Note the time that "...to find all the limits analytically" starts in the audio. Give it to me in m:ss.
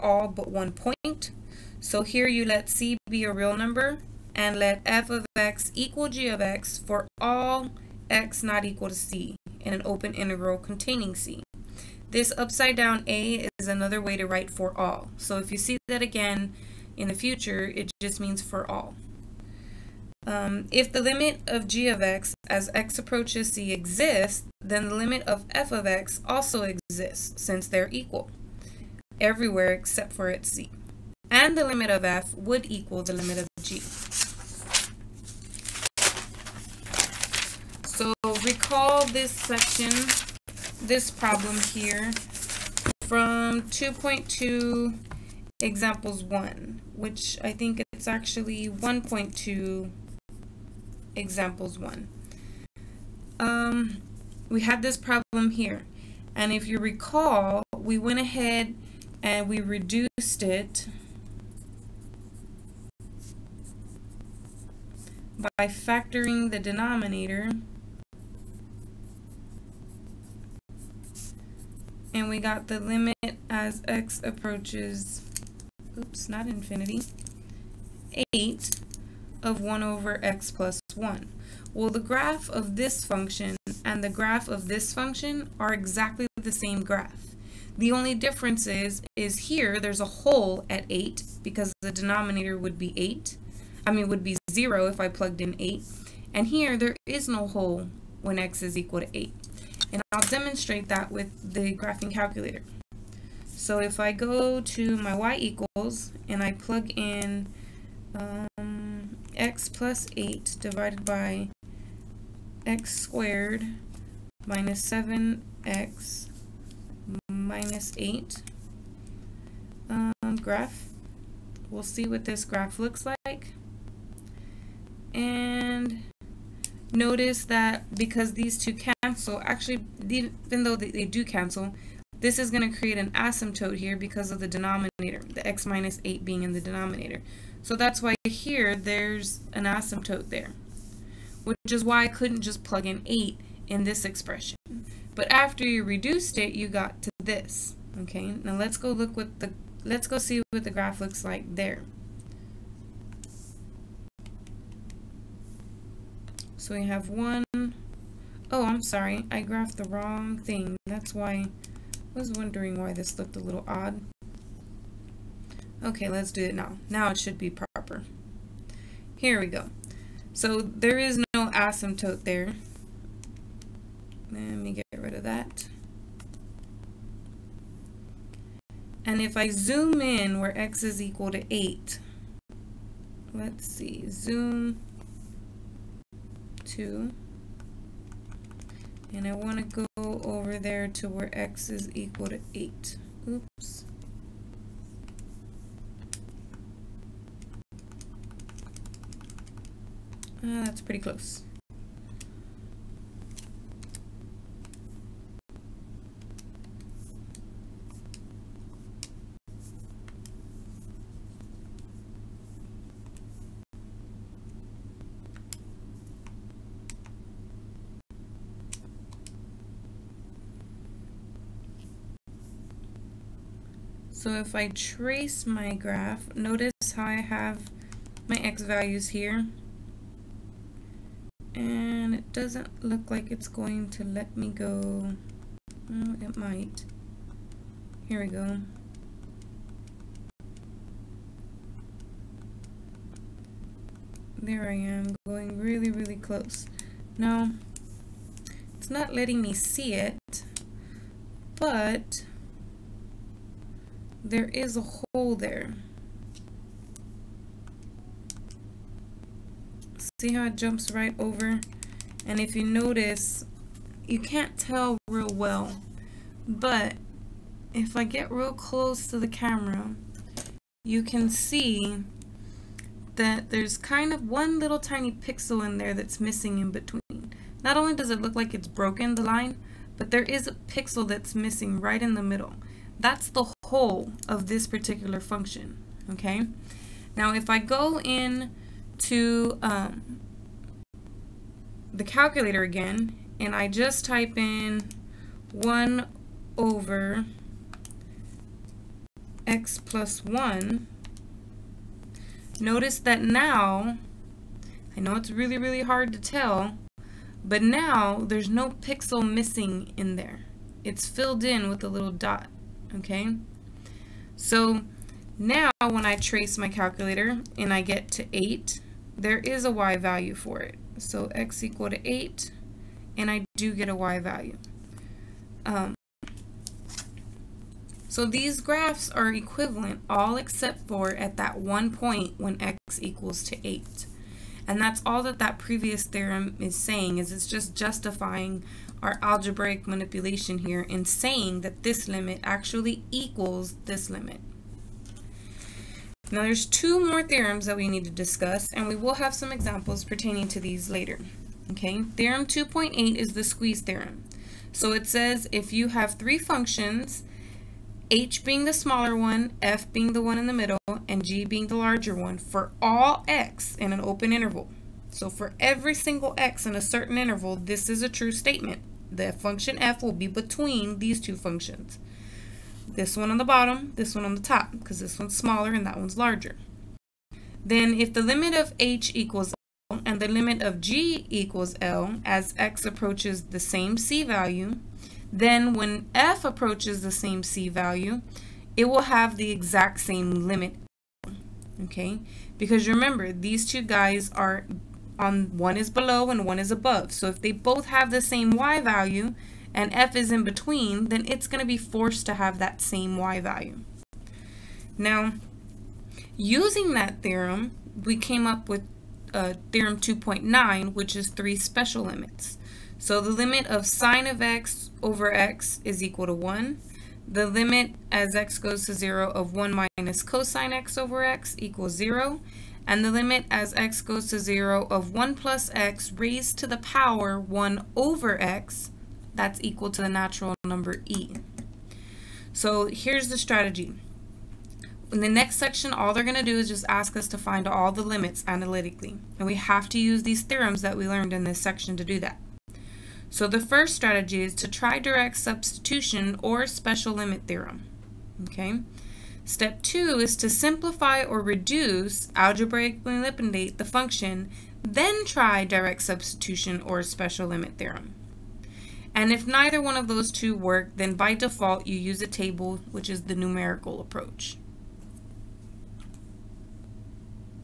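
7:17.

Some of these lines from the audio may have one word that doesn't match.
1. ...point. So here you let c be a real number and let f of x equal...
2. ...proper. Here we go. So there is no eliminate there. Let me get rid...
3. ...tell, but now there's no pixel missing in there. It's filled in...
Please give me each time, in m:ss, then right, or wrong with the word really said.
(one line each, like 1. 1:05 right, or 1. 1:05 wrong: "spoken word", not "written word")
1. 0:00 right
2. 2:47 wrong: "asymptote", not "eliminate"
3. 5:06 right.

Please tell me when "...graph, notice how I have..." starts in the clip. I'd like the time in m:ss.
3:45.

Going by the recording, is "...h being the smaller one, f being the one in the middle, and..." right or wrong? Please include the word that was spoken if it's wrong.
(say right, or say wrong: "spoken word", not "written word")
right.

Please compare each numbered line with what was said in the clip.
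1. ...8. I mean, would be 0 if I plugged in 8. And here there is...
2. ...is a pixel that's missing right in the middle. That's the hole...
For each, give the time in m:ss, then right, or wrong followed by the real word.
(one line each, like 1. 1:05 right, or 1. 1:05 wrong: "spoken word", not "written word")
1. 1:32 right
2. 4:40 right.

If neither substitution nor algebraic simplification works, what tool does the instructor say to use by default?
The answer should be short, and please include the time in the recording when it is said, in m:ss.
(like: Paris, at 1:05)
a table, at 7:42.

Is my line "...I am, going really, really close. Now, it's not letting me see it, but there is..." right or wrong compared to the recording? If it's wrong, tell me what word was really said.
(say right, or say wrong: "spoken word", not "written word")
right.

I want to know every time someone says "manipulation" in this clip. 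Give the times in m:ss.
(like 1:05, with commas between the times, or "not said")
5:39.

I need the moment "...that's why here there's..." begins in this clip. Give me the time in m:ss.
2:17.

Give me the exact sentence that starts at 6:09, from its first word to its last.
The function f will be between these two functions.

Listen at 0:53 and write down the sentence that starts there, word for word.
Um, we had this problem here.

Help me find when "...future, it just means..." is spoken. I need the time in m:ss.
0:17.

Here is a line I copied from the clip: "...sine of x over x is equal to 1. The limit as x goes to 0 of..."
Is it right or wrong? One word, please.
right.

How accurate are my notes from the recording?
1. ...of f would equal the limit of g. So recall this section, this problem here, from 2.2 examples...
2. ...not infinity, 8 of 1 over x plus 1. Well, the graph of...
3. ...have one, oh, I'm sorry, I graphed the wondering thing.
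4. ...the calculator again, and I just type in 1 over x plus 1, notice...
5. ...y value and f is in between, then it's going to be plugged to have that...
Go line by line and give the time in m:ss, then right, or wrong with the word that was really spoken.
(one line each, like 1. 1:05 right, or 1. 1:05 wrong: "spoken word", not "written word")
1. 0:31 right
2. 1:16 right
3. 2:36 wrong: "wrong", not "wondering"
4. 4:51 right
5. 6:38 wrong: "forced", not "plugged".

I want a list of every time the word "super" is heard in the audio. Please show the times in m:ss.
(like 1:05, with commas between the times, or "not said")
not said.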